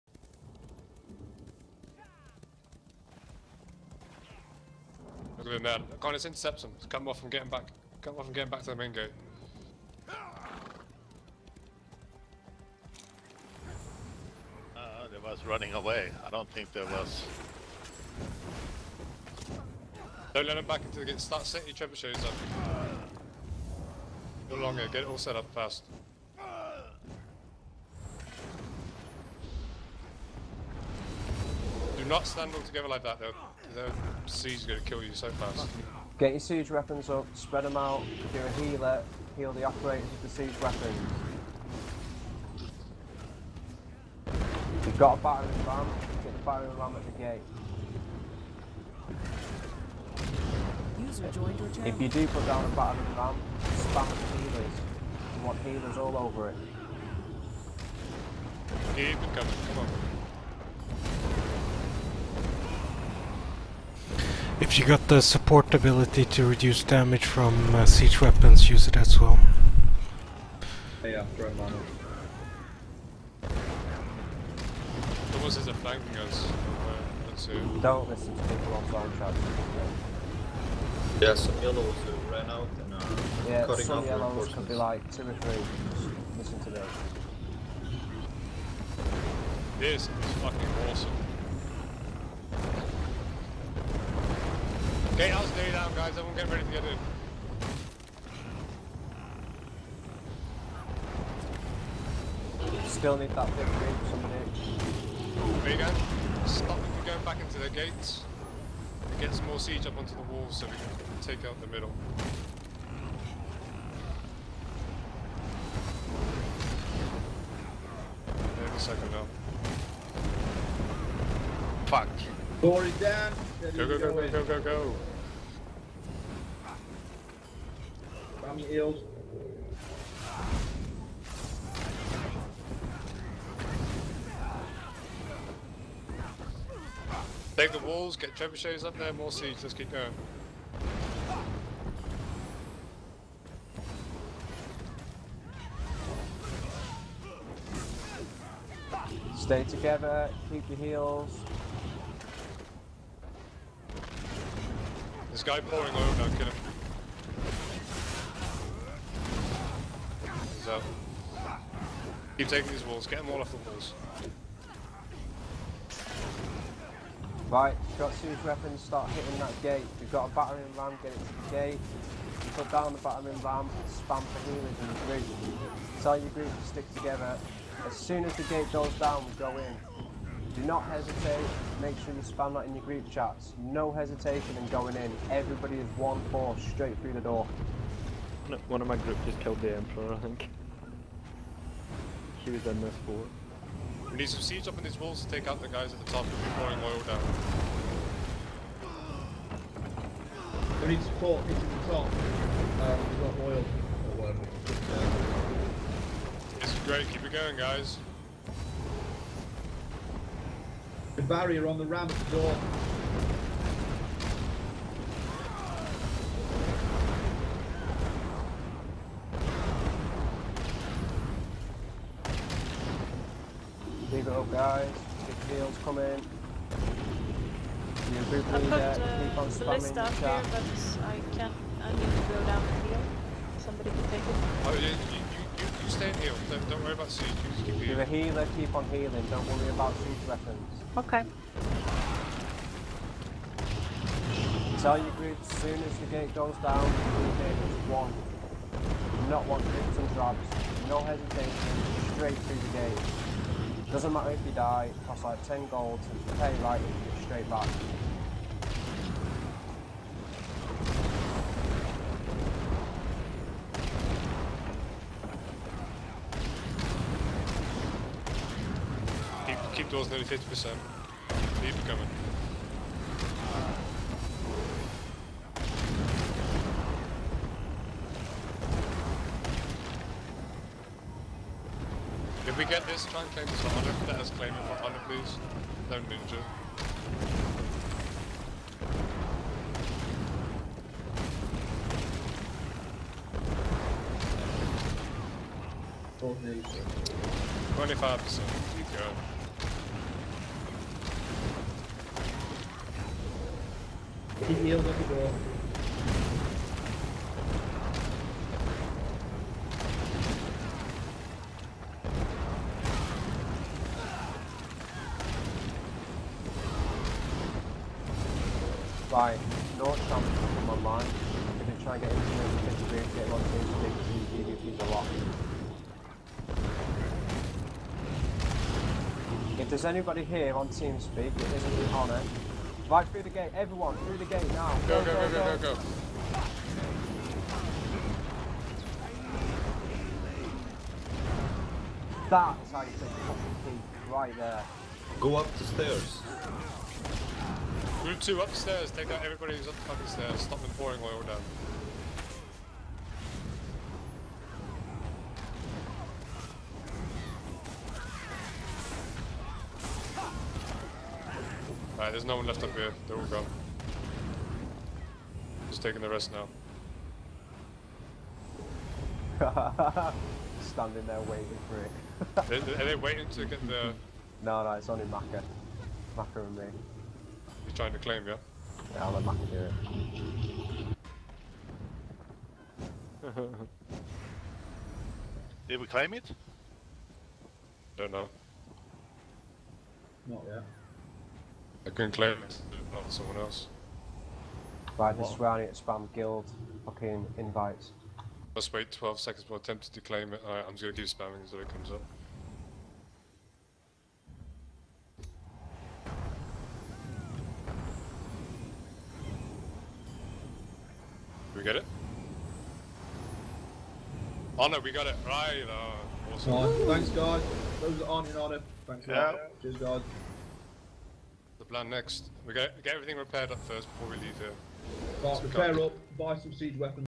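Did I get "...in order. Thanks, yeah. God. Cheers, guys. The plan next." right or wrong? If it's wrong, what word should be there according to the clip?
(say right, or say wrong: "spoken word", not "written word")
right.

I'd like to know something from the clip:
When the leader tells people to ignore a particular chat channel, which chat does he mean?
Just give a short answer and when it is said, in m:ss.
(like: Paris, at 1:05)
flank chat, at 1:18.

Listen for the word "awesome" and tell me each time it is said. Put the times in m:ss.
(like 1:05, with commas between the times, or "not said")
1:30, 6:56.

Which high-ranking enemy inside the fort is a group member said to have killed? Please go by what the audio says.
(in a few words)
the Emperor.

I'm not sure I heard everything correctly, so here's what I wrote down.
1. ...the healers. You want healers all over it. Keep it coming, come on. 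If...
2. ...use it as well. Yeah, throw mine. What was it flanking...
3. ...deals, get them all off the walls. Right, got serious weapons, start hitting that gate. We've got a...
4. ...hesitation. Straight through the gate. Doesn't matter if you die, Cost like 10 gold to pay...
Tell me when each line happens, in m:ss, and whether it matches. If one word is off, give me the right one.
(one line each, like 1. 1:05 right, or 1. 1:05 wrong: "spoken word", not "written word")
1. 0:54 right
2. 1:08 right
3. 2:42 wrong: "walls", not "deals"
4. 4:10 right.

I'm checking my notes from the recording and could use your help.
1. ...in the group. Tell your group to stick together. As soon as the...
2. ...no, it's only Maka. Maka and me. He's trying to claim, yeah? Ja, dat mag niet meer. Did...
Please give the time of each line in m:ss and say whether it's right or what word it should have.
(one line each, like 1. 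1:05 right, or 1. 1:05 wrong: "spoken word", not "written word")
1. 2:54 right
2. 6:14 right.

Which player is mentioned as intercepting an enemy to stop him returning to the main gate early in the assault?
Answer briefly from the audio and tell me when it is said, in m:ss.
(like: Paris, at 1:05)
Connors, at 0:05.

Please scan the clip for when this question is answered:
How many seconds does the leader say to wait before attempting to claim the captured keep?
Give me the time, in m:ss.
6:38.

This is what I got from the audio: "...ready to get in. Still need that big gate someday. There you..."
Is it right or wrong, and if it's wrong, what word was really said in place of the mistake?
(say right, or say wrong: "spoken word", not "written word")
right.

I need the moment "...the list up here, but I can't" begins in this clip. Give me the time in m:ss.
3:49.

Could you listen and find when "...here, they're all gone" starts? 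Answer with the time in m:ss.
6:02.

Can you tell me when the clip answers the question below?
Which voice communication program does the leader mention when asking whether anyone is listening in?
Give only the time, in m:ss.
5:30.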